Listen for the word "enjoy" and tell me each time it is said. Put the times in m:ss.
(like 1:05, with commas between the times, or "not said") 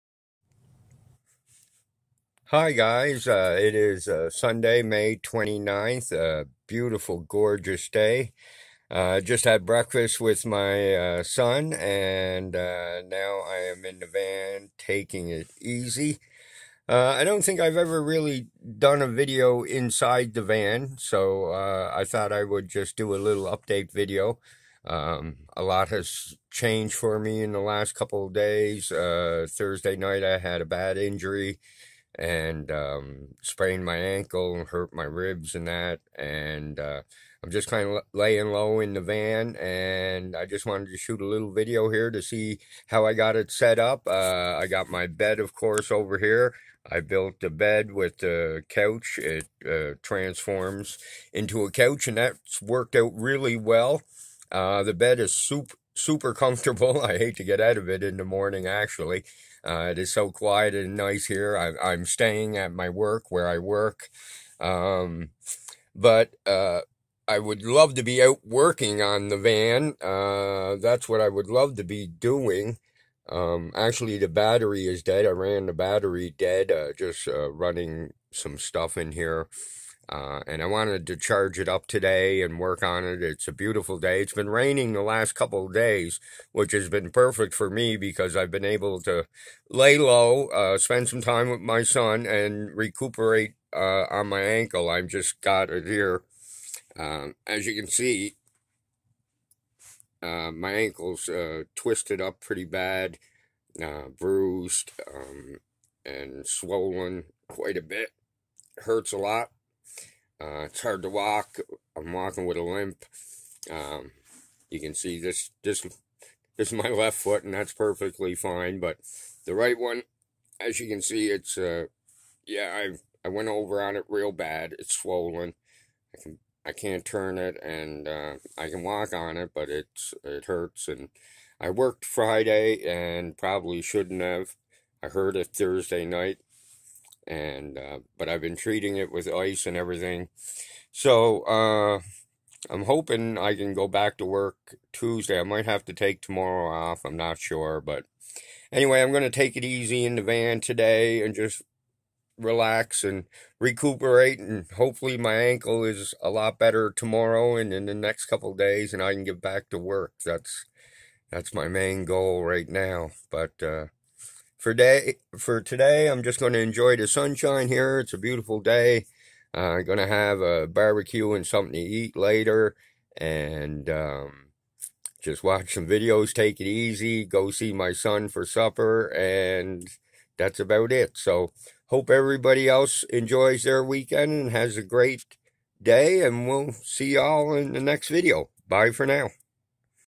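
2:46, 3:03.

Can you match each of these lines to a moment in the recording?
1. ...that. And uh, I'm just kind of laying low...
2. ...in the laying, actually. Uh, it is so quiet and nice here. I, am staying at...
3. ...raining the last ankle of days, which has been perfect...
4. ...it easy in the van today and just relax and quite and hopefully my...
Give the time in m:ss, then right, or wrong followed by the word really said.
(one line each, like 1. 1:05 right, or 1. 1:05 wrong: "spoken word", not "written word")
1. 0:35 right
2. 0:58 wrong: "morning", not "laying"
3. 1:24 wrong: "couple", not "ankle"
4. 2:29 wrong: "recuperate", not "quite".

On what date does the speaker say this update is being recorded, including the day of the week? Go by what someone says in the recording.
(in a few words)
Sunday, May 29th.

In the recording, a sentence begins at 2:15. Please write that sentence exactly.
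I heard it Thursday night and uh, but I've been treating it with ice and everything.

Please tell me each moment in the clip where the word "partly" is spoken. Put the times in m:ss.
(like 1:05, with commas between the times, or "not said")
not said.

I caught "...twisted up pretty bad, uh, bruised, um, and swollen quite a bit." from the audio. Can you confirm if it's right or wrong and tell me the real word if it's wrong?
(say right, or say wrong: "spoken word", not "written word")
right.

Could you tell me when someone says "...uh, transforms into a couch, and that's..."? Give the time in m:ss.
0:49.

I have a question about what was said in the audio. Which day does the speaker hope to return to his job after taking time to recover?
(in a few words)
Tuesday.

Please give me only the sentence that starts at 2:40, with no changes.
That's that's my main goal right now.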